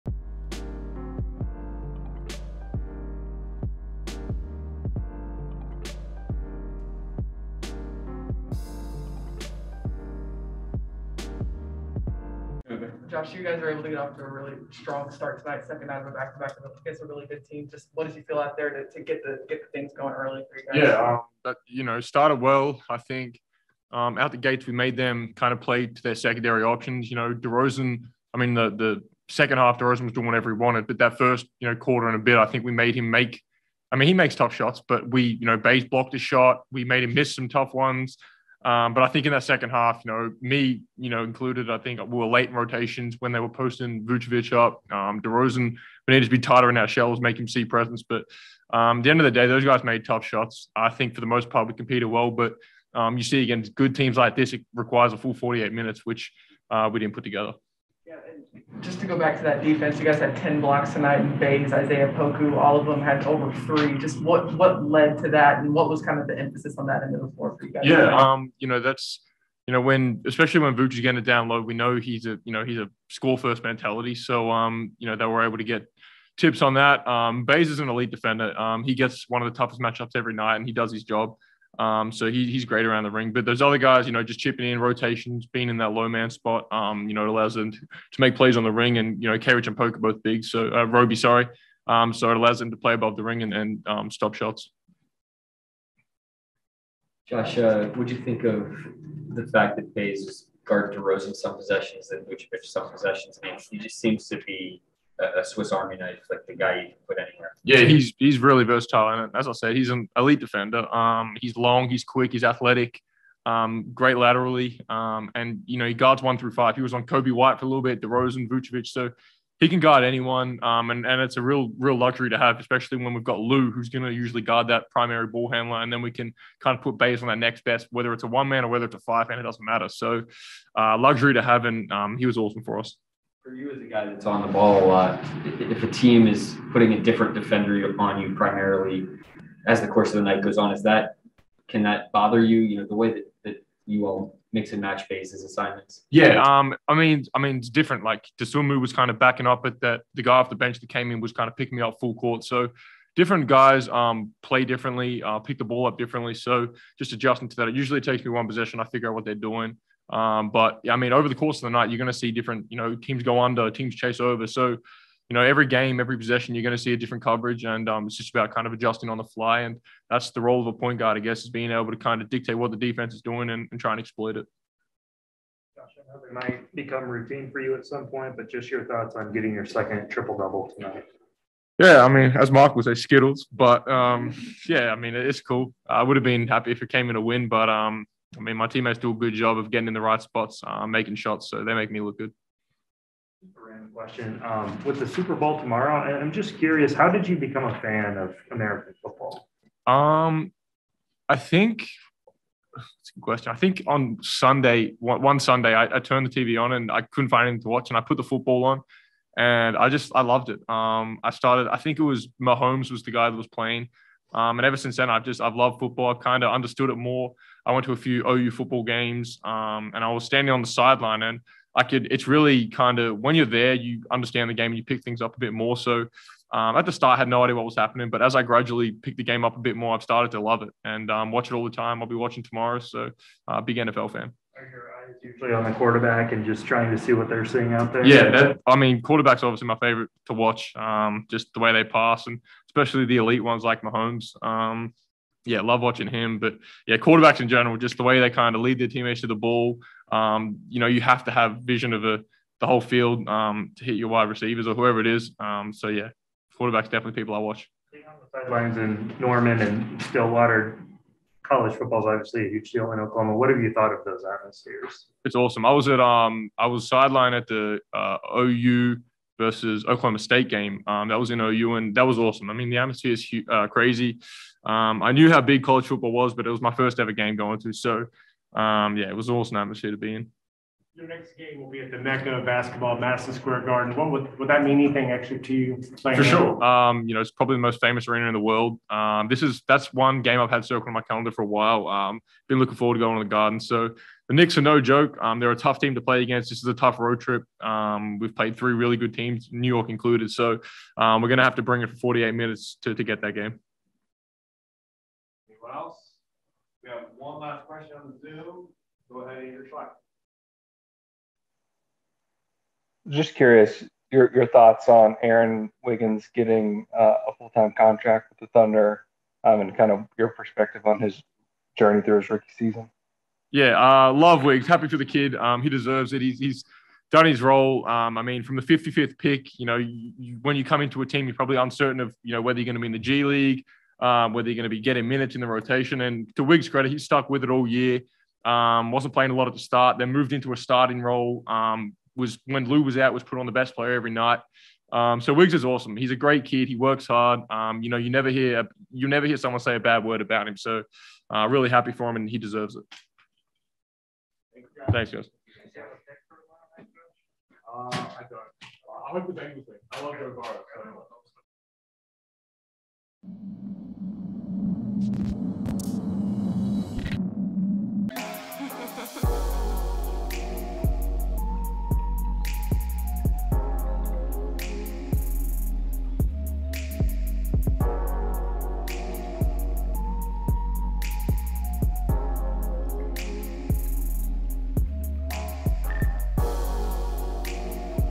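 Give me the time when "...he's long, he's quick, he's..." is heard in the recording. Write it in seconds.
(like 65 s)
111 s.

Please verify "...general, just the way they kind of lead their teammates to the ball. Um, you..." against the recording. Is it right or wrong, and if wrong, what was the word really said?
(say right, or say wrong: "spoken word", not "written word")
right.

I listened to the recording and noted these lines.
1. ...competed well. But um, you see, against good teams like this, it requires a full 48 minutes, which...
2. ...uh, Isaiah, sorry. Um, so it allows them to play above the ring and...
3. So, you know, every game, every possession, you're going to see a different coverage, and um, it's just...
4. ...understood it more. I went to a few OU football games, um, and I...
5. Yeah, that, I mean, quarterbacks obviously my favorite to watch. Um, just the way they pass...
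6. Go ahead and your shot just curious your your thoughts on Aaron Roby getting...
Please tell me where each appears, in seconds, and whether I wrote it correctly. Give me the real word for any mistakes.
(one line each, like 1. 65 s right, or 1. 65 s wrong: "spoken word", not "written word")
1. 51 s right
2. 90 s wrong: "Roby", not "Isaiah"
3. 164 s right
4. 216 s right
5. 238 s right
6. 309 s wrong: "Wiggins", not "Roby".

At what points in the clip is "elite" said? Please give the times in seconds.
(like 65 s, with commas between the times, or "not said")
77 s, 110 s, 243 s.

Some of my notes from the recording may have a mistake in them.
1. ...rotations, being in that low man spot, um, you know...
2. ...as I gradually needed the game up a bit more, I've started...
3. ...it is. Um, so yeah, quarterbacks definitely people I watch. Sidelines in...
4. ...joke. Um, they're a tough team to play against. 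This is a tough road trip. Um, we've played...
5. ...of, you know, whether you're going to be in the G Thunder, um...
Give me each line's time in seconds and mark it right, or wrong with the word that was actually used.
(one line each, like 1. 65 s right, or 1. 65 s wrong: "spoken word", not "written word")
1. 84 s right
2. 228 s wrong: "picked", not "needed"
3. 254 s right
4. 294 s right
5. 331 s wrong: "League", not "Thunder".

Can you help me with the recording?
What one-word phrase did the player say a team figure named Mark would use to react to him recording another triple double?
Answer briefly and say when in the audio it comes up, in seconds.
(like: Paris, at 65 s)
Skittles, at 182 s.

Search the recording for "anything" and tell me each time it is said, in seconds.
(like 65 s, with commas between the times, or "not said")
207 s, 284 s.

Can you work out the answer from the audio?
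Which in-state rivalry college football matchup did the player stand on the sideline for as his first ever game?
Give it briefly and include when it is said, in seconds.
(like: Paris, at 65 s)
OU versus Oklahoma State, at 268 s.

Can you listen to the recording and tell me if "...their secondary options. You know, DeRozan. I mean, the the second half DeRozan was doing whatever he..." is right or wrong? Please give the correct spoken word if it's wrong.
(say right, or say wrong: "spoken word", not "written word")
right.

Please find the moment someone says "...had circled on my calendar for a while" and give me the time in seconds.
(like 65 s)
290 s.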